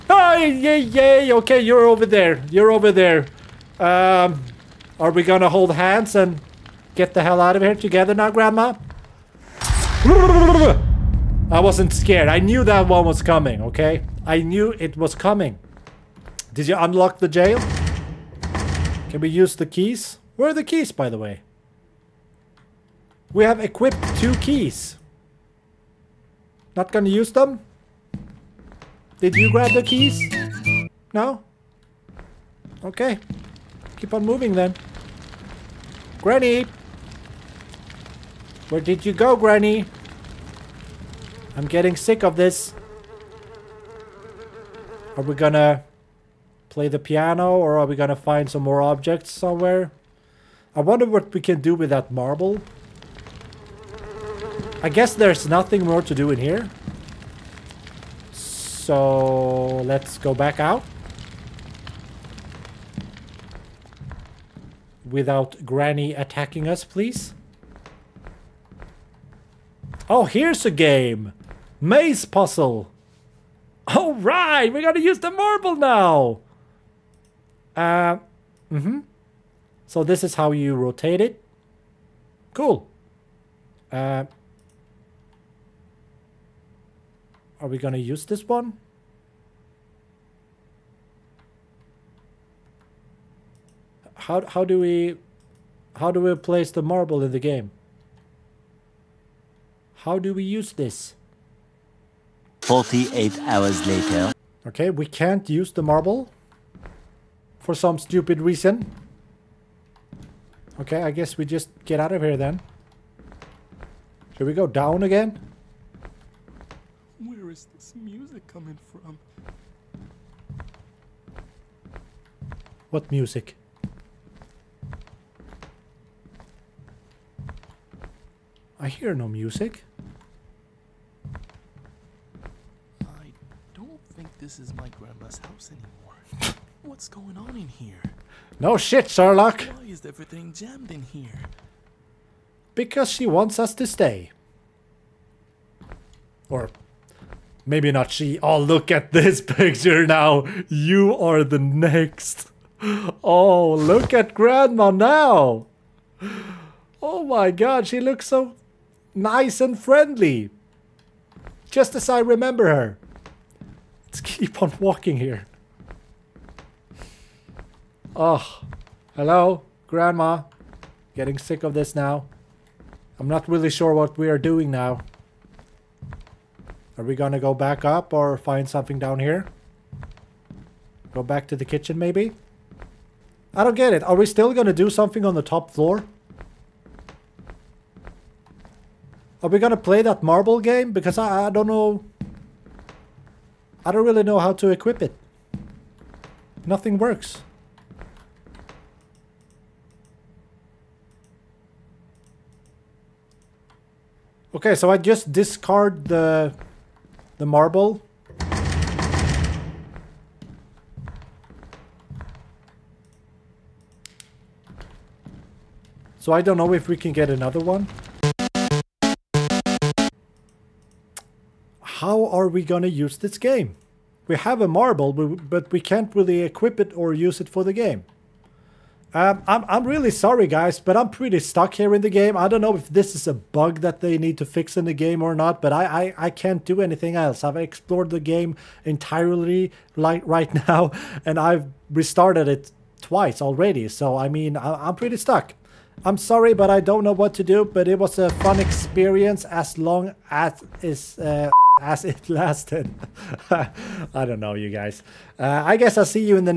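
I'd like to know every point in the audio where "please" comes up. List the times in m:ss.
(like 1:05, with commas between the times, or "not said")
1:06.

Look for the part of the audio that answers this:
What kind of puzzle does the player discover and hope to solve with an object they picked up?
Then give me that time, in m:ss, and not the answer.
1:11.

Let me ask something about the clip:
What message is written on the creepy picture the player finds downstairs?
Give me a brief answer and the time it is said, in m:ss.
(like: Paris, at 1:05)
You are the next, at 2:30.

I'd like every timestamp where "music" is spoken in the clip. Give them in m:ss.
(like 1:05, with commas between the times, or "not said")
1:57, 2:03, 2:09.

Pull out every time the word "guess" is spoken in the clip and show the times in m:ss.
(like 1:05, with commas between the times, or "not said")
0:54, 1:51, 4:15.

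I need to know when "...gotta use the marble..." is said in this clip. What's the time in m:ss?
1:14.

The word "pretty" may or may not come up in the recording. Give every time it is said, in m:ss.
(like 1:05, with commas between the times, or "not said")
3:51, 4:04.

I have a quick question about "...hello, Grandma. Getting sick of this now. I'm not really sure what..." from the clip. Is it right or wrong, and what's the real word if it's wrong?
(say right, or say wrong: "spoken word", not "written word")
right.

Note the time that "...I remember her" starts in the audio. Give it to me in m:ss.
2:42.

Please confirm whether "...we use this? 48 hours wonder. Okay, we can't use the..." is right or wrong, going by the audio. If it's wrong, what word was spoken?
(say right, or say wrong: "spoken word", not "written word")
wrong: "later", not "wonder".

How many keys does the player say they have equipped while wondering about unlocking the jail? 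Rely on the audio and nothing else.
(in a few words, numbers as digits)
2.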